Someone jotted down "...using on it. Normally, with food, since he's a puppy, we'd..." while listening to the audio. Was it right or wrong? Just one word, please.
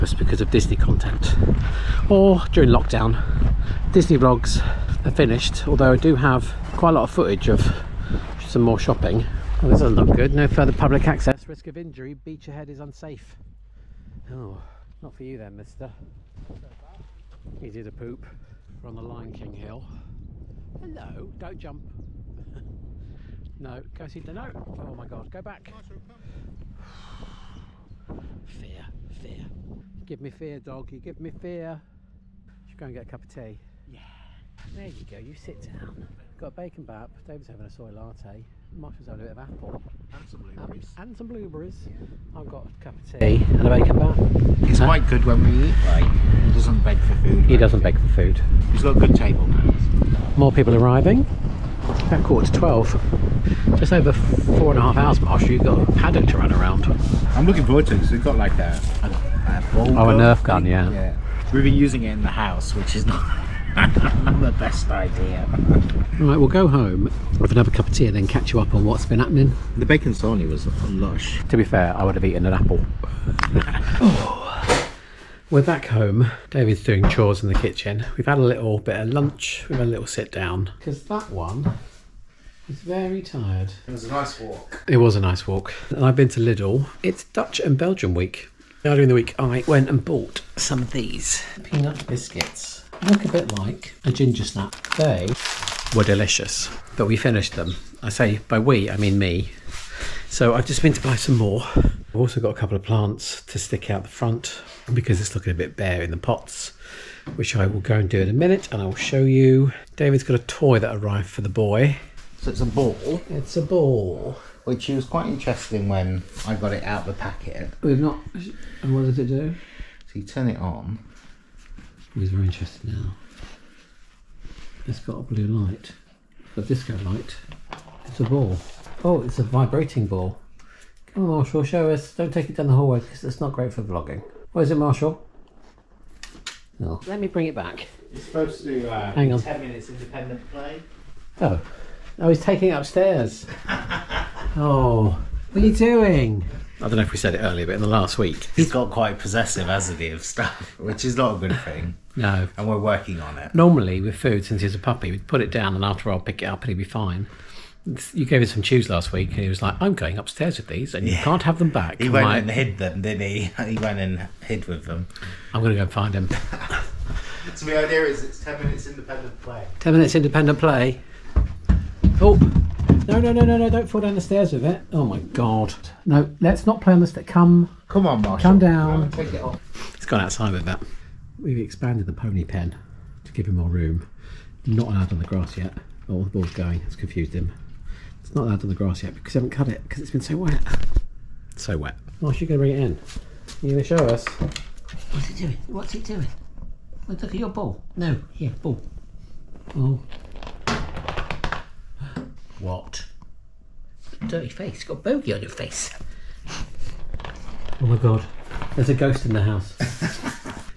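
wrong.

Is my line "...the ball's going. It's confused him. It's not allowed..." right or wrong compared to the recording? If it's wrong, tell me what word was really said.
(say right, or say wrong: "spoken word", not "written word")
right.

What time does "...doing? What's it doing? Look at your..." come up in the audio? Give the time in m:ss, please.
3:15.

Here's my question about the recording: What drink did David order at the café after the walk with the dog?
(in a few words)
Soy latte.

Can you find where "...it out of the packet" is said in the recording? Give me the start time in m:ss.
1:56.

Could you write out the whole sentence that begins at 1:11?
To be fair, I would have eaten an apple.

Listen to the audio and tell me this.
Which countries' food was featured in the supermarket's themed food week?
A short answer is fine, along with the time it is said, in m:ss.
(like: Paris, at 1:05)
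Dutch and Belgian, at 1:27.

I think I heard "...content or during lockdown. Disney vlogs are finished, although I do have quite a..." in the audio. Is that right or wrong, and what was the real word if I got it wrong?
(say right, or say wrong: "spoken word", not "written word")
right.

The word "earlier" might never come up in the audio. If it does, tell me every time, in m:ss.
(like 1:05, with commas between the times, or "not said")
1:28, 2:27.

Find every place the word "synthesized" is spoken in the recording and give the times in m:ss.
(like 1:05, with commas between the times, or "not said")
not said.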